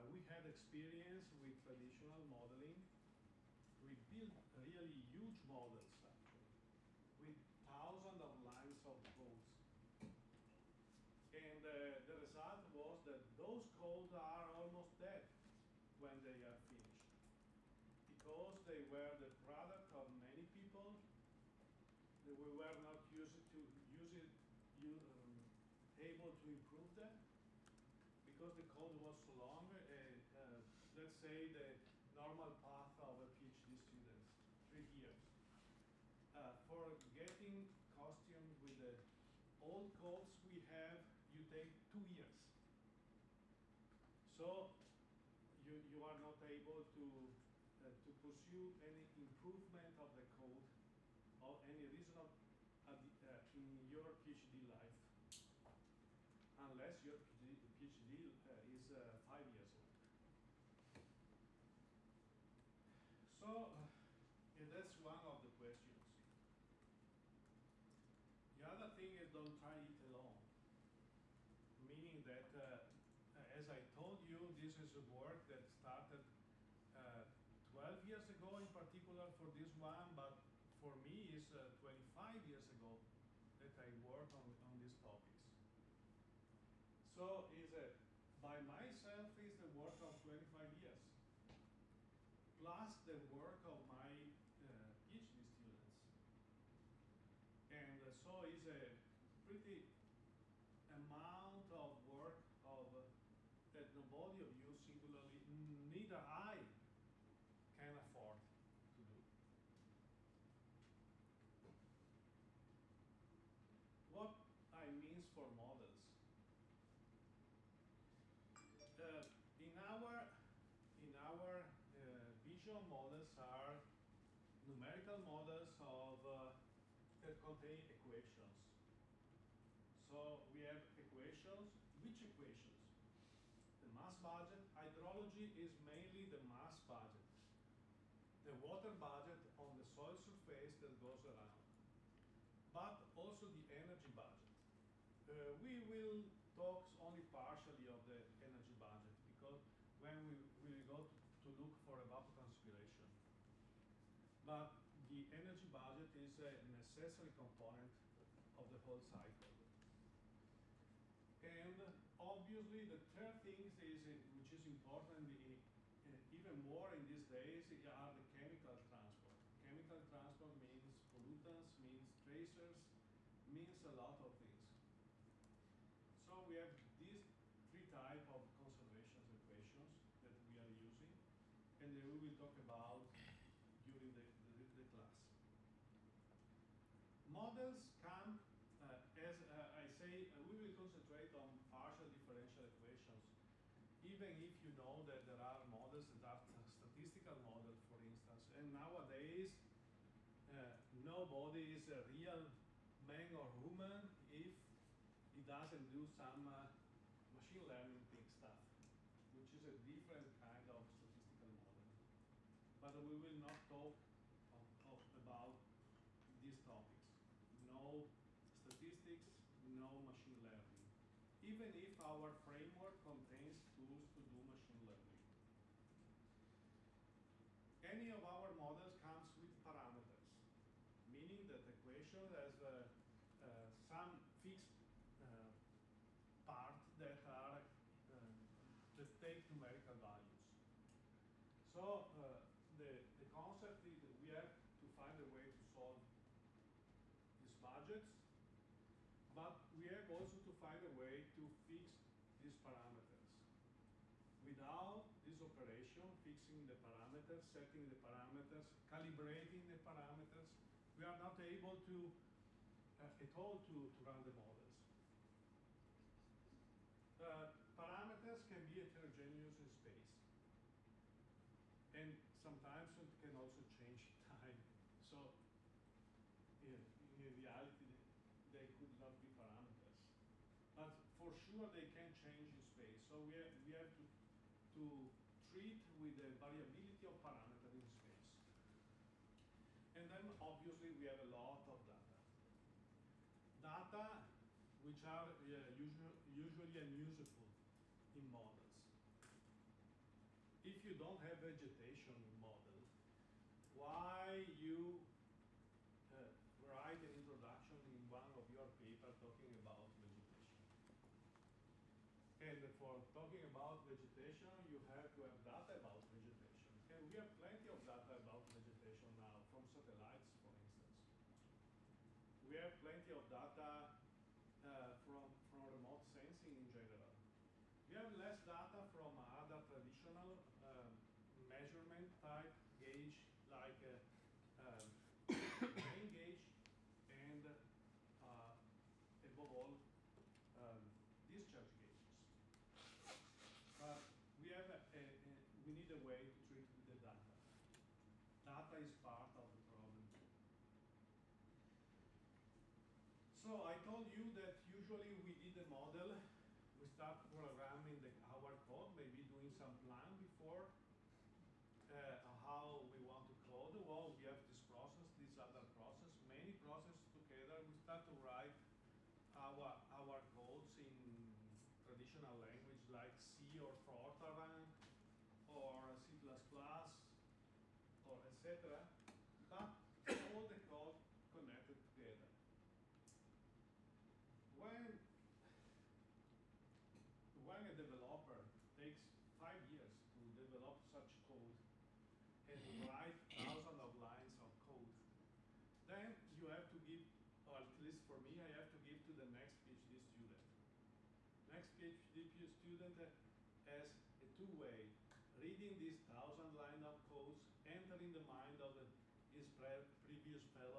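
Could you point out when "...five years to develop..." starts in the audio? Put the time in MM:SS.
06:29.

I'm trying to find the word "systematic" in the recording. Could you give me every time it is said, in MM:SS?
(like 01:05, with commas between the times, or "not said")
not said.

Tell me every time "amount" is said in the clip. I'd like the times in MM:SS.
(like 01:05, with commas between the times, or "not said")
01:40.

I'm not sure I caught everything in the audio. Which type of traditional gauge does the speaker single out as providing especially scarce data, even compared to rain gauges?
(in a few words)
Discharge gauges.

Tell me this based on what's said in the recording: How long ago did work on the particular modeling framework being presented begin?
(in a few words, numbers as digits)
12 years ago.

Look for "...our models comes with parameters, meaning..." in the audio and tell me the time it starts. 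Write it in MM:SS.
03:48.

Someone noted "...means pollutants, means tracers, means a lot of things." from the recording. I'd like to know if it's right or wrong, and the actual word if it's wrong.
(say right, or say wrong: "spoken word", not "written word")
right.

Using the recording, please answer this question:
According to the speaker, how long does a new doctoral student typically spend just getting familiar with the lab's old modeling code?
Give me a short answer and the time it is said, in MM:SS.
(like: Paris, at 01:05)
2 years, at 00:41.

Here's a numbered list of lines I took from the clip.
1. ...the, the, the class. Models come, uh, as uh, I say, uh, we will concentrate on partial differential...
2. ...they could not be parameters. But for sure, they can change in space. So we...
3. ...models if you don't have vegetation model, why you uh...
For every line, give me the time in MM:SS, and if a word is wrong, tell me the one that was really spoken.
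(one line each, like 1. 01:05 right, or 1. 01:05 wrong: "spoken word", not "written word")
1. 03:04 right
2. 04:38 right
3. 04:58 right.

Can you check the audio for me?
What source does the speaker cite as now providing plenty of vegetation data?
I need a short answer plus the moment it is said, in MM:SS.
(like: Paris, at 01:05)
Satellites, at 05:19.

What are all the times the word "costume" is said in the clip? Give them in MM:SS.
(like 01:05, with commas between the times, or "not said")
00:37.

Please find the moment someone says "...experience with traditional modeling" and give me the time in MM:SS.
00:00.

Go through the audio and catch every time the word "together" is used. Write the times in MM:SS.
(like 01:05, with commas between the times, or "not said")
06:07, 06:21.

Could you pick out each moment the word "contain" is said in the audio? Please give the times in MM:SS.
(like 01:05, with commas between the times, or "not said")
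02:07, 03:43.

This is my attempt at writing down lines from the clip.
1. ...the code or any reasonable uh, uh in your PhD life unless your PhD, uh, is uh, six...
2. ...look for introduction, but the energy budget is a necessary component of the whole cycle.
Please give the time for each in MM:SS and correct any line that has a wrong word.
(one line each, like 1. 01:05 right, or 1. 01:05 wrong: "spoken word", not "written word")
1. 00:50 wrong: "five", not "six"
2. 02:31 wrong: "evapotranspiration", not "introduction".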